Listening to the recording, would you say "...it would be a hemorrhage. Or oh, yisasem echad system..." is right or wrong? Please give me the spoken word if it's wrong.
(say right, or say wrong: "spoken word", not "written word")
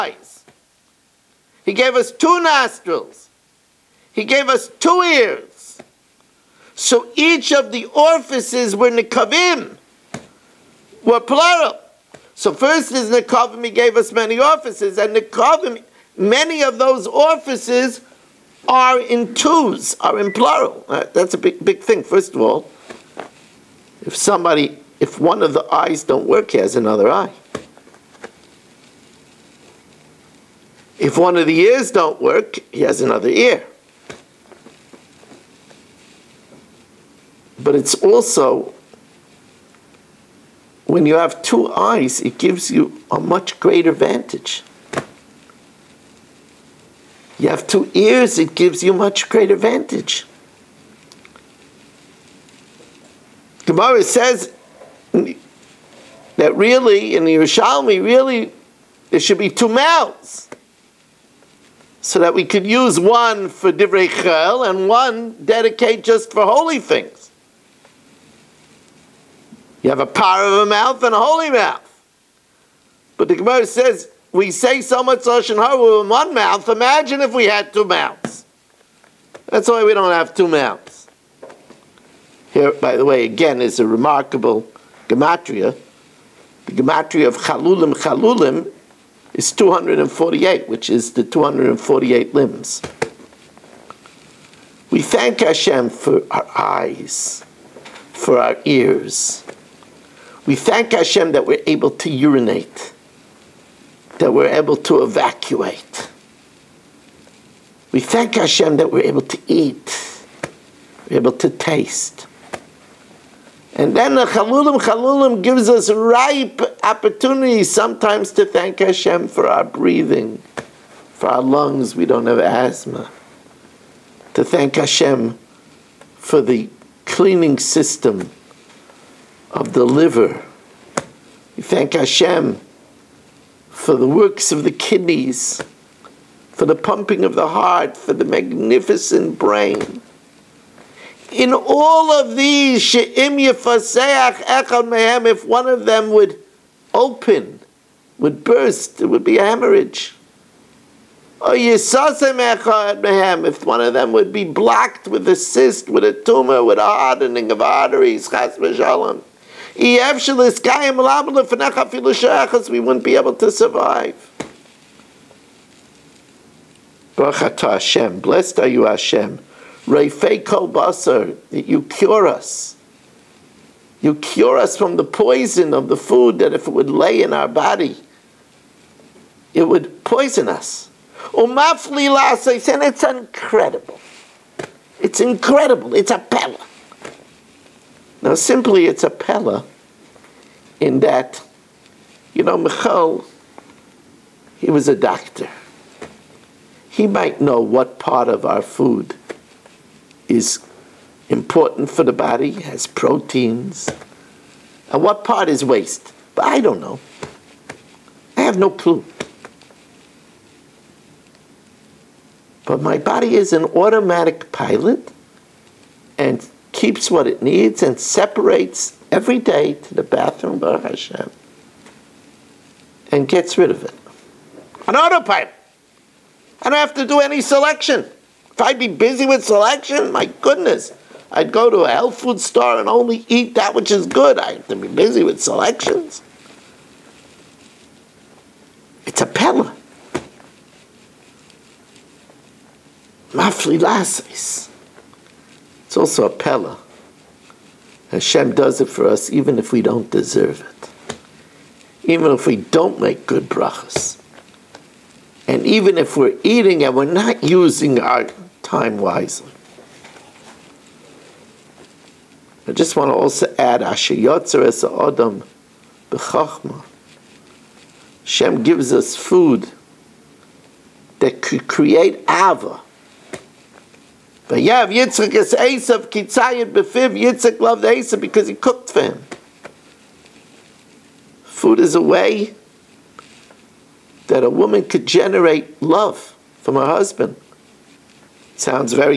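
wrong: "mehem", not "system".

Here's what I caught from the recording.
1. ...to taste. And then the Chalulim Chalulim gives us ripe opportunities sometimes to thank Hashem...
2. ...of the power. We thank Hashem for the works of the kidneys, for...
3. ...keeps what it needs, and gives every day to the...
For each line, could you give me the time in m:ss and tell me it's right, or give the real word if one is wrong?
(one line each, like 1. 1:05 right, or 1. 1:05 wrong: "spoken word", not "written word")
1. 1:51 right
2. 2:09 wrong: "liver", not "power"
3. 3:36 wrong: "separates", not "gives".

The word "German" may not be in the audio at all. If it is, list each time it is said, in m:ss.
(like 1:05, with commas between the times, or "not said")
not said.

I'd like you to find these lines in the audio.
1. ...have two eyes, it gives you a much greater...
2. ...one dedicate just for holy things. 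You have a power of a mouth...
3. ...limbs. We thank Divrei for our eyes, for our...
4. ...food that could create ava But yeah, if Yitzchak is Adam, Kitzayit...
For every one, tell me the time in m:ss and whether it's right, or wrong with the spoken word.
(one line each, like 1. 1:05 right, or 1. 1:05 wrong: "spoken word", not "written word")
1. 0:41 right
2. 1:04 right
3. 1:32 wrong: "Hashem", not "Divrei"
4. 4:29 wrong: "Esav", not "Adam".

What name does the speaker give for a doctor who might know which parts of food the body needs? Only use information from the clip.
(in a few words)
Michal.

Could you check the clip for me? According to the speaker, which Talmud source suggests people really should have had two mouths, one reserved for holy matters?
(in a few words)
Yerushalmi.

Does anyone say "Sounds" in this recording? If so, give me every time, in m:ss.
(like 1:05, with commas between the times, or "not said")
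4:48.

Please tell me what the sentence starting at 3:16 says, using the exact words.
He might know what part of our food is important for the body, has proteins, and what part is waste.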